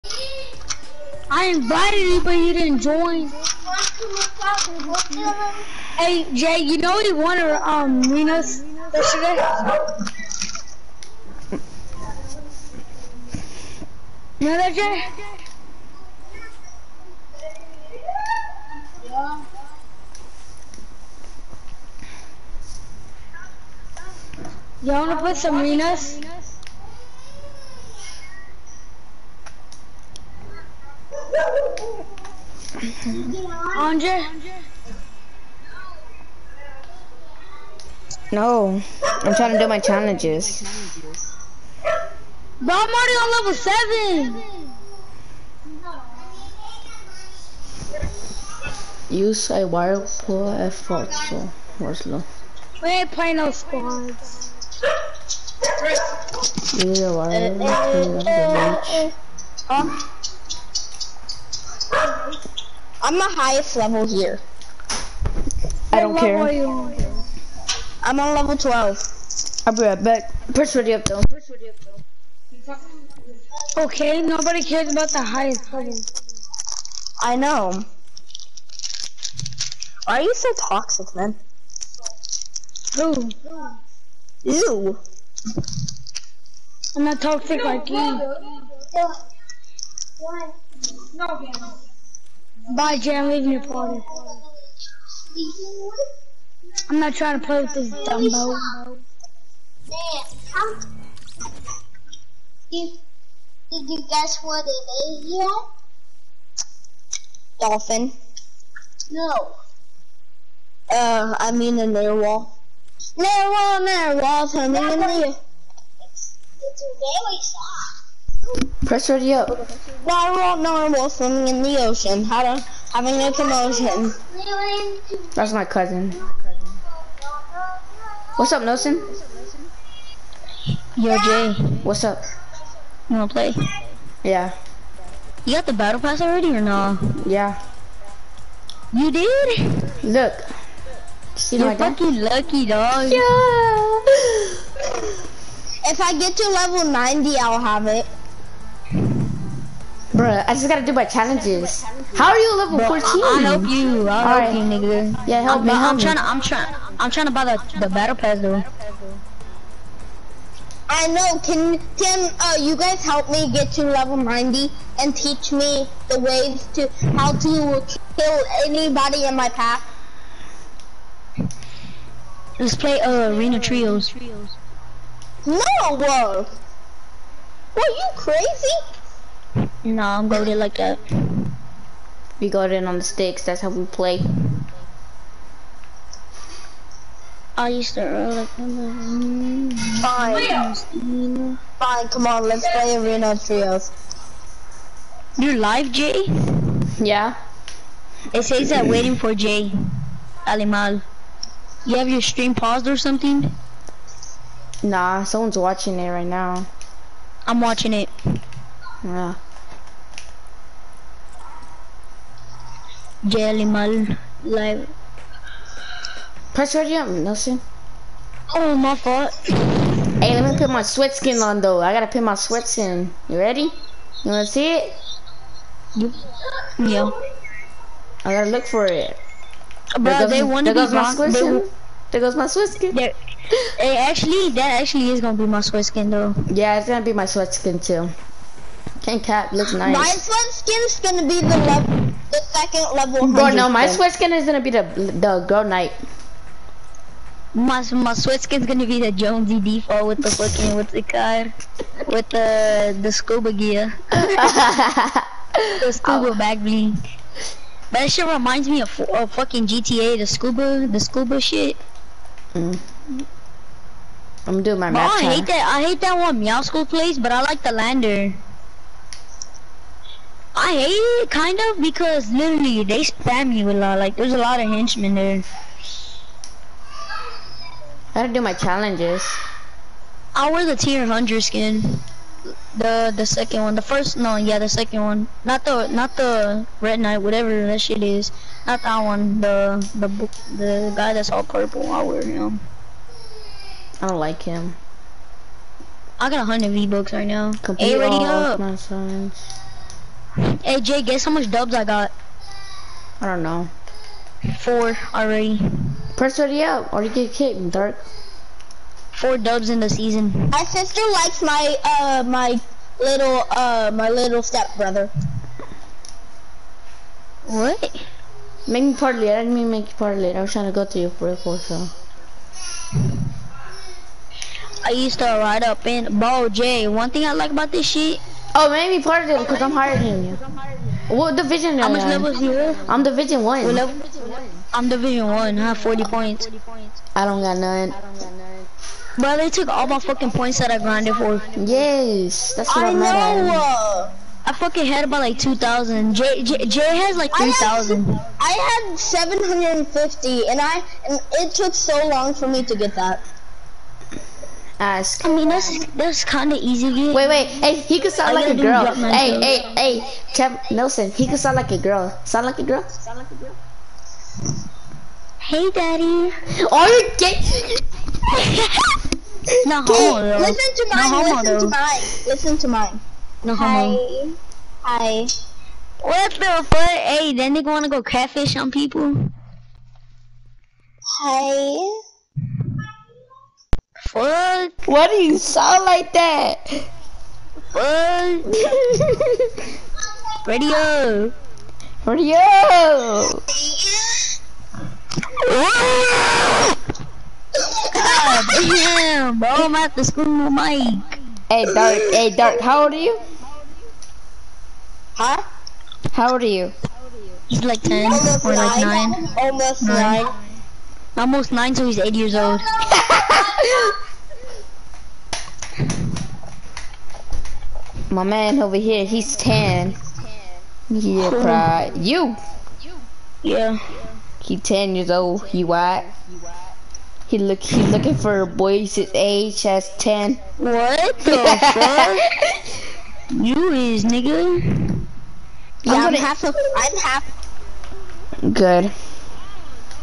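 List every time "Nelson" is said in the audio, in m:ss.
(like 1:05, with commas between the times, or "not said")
2:08, 3:37, 6:00.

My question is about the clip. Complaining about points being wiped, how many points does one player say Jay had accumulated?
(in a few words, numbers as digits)
3,000.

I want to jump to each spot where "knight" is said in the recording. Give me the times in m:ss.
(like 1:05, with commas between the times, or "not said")
4:05, 4:46.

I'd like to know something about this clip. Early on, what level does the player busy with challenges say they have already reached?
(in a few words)
Level 7.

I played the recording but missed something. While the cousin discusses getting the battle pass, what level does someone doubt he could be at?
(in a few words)
Level 14.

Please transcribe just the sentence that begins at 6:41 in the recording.
Hey, Dark, hey, Dark, how old are you?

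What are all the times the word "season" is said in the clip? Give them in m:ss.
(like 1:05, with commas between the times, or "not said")
5:09.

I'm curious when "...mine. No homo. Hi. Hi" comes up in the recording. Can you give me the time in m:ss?
6:12.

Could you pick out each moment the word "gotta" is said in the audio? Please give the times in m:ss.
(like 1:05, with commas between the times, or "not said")
2:30, 3:41, 3:48, 4:38.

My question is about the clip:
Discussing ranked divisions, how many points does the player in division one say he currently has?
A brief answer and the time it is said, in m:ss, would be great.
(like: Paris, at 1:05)
40, at 5:35.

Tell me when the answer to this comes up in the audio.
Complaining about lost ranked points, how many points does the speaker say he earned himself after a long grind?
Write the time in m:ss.
5:48.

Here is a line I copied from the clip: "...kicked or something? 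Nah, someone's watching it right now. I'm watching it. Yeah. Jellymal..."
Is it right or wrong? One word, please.
wrong.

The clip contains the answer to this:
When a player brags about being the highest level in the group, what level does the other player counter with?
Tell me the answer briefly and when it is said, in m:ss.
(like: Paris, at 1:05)
Level 12, at 1:08.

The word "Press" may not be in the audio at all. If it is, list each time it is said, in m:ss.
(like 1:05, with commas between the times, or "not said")
1:58, 3:36, 5:06.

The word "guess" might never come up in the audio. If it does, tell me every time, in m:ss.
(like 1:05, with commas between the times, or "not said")
1:44, 5:01.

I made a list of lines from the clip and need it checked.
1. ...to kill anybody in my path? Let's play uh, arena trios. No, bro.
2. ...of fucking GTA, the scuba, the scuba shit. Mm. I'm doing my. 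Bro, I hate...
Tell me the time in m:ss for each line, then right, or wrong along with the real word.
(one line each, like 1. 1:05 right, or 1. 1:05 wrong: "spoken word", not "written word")
1. 2:47 right
2. 4:19 right.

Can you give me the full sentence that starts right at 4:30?
I hate it, kind of, because literally they spam you a lot.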